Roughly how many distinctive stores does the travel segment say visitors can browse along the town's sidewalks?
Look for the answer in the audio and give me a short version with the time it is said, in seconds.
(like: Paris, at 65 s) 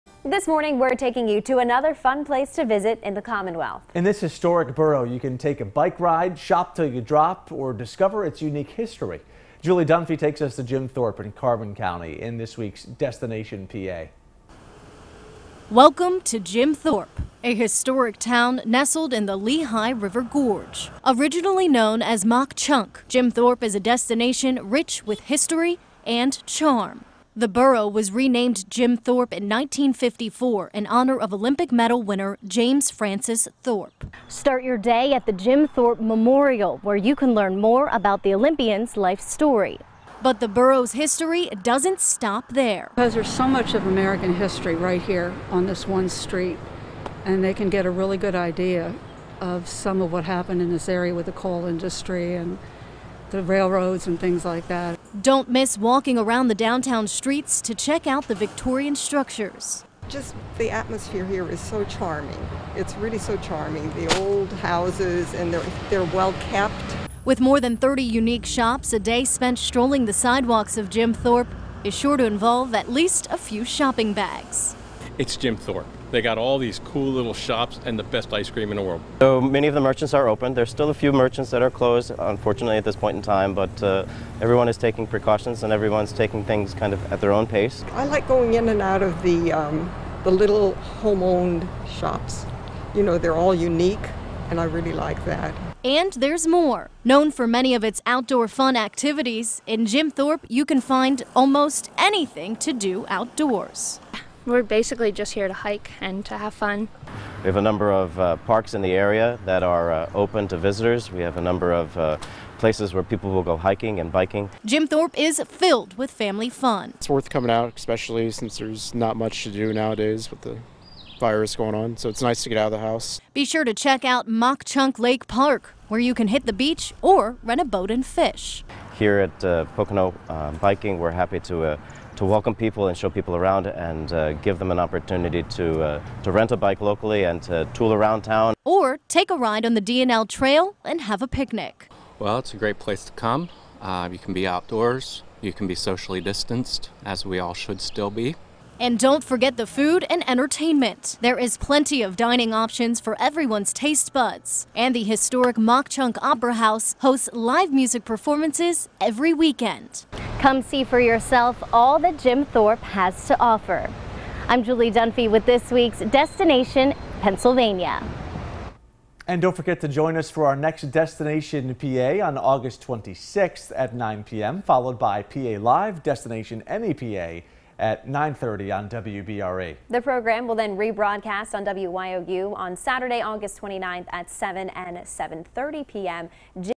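more than 30, at 67 s.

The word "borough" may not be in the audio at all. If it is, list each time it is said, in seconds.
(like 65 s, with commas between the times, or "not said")
4 s, 27 s, 40 s.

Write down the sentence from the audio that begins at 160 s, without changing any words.
Come see for yourself all that Jim Thorpe has to offer.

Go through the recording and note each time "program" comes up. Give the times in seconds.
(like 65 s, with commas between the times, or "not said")
180 s.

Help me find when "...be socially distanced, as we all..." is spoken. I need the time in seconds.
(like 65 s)
145 s.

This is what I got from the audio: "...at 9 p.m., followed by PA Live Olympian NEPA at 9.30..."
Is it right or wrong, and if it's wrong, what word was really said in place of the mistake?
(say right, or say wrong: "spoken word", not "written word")
wrong: "Destination", not "Olympian".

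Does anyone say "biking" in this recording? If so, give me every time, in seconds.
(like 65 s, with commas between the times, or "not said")
114 s, 130 s.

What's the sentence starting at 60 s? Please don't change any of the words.
Just the atmosphere here is so charming.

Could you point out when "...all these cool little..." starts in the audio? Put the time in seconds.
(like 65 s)
76 s.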